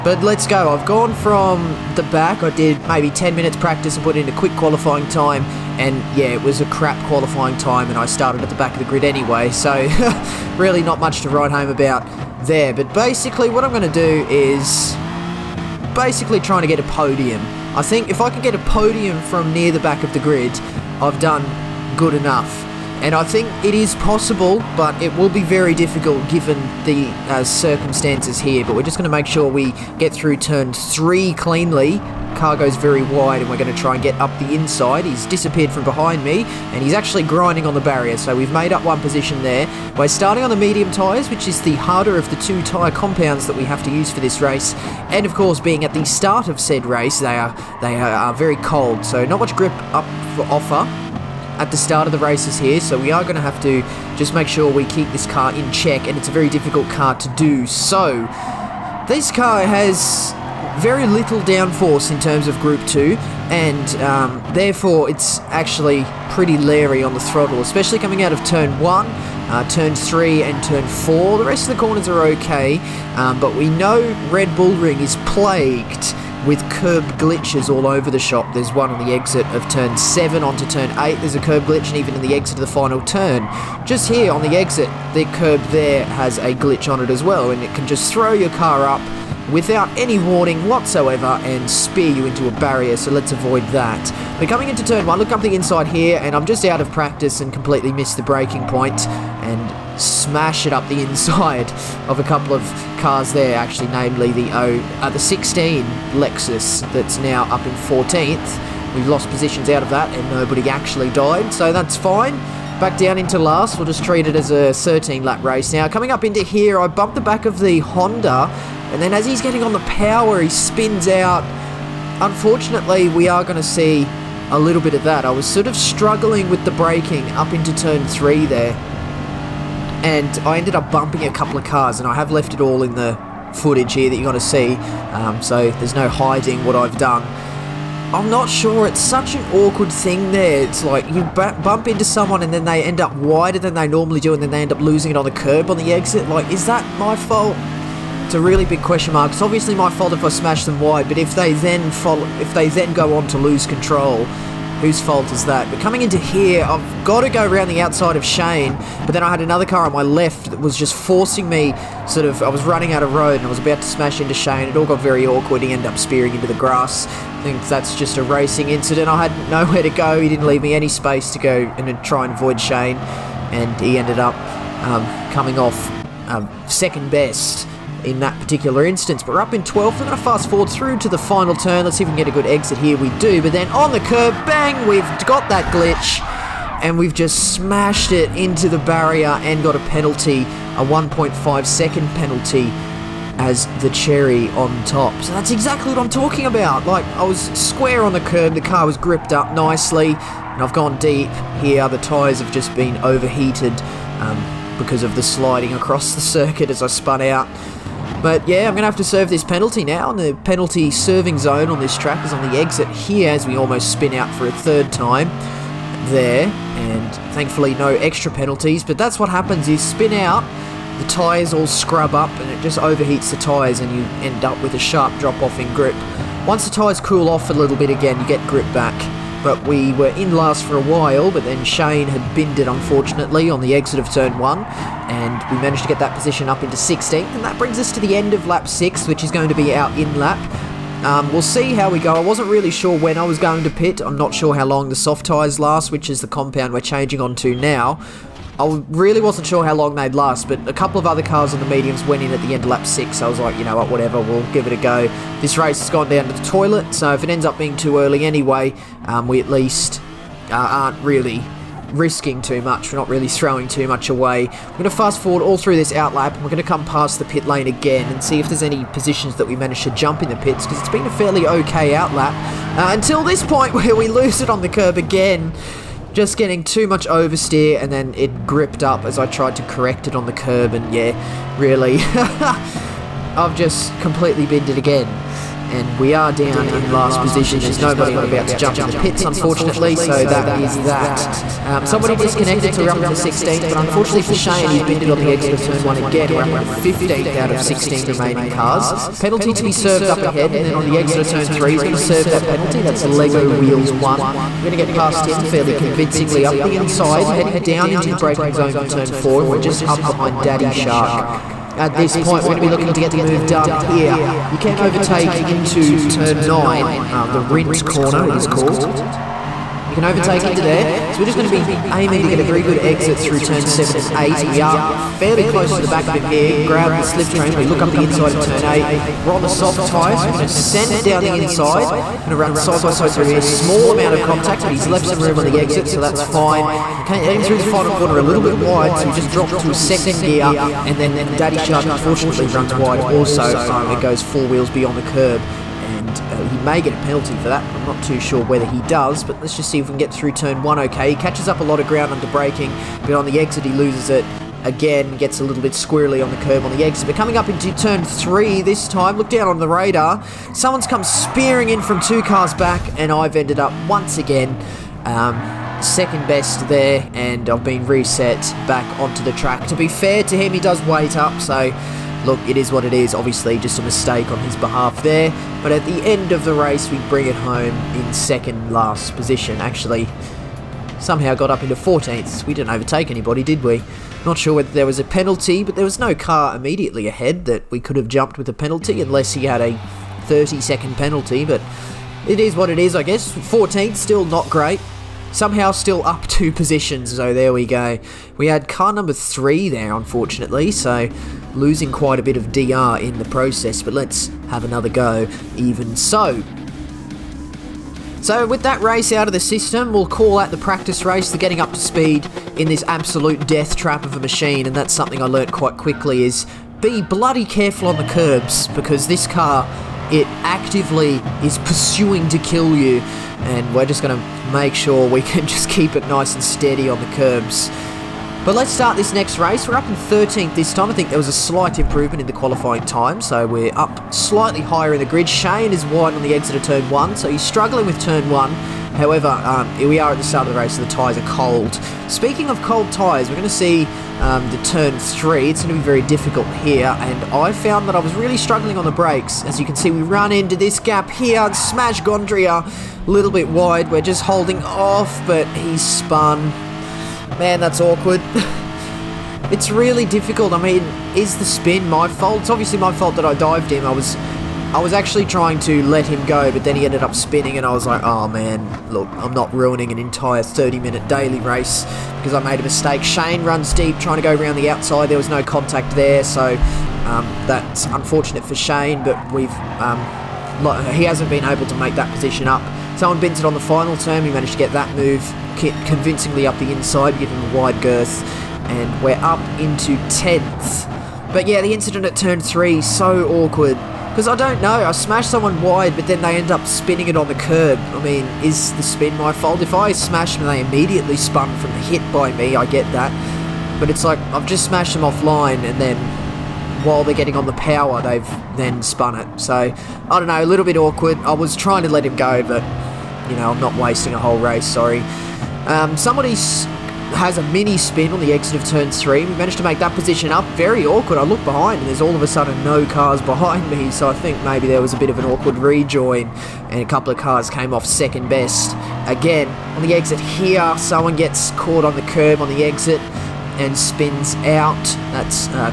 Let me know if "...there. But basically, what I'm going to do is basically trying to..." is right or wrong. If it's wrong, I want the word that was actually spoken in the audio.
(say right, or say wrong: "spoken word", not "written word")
right.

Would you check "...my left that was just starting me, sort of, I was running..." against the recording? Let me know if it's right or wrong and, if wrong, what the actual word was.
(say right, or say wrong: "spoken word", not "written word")
wrong: "forcing", not "starting".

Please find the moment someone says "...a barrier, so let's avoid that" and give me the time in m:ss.
1:32.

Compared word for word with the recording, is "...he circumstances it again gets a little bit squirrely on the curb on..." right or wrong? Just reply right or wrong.
wrong.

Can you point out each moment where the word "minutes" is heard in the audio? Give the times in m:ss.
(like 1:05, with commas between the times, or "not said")
0:03, 7:50.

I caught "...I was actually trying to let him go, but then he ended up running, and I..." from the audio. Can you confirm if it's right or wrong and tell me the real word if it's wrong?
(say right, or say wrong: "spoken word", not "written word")
wrong: "spinning", not "running".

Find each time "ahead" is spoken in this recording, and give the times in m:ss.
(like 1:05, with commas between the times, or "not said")
5:00, 6:27.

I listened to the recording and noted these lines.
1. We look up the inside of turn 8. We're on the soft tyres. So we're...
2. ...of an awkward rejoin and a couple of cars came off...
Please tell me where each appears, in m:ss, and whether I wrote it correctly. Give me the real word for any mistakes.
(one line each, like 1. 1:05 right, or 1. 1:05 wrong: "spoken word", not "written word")
1. 5:27 right
2. 8:45 right.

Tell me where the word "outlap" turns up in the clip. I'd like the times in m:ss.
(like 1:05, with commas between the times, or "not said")
4:25, 4:31.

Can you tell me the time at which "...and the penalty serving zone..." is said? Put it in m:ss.
3:30.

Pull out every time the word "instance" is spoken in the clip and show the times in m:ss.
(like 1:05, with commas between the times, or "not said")
2:58.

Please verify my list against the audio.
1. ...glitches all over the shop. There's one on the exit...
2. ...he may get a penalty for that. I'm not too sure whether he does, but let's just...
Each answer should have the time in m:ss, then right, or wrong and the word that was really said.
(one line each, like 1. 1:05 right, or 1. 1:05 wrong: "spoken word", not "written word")
1. 1:17 right
2. 5:46 right.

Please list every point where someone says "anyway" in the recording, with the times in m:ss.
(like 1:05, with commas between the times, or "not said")
0:09, 4:18.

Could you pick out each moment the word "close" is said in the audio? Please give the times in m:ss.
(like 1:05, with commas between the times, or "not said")
5:25.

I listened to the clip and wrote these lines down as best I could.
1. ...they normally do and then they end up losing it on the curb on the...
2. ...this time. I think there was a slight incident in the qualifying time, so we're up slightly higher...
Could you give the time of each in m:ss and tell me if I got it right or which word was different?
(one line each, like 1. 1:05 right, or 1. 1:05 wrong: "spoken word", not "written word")
1. 2:23 right
2. 7:10 wrong: "improvement", not "incident".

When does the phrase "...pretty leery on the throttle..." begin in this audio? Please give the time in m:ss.
1:06.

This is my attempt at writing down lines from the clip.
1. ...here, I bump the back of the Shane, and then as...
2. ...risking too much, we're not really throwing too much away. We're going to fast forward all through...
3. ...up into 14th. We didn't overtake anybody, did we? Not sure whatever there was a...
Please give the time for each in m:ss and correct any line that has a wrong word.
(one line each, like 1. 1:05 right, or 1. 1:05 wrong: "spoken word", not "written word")
1. 1:56 wrong: "Honda", not "Shane"
2. 4:21 right
3. 6:21 wrong: "whether", not "whatever".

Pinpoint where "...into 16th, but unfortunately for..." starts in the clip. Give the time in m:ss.
4:53.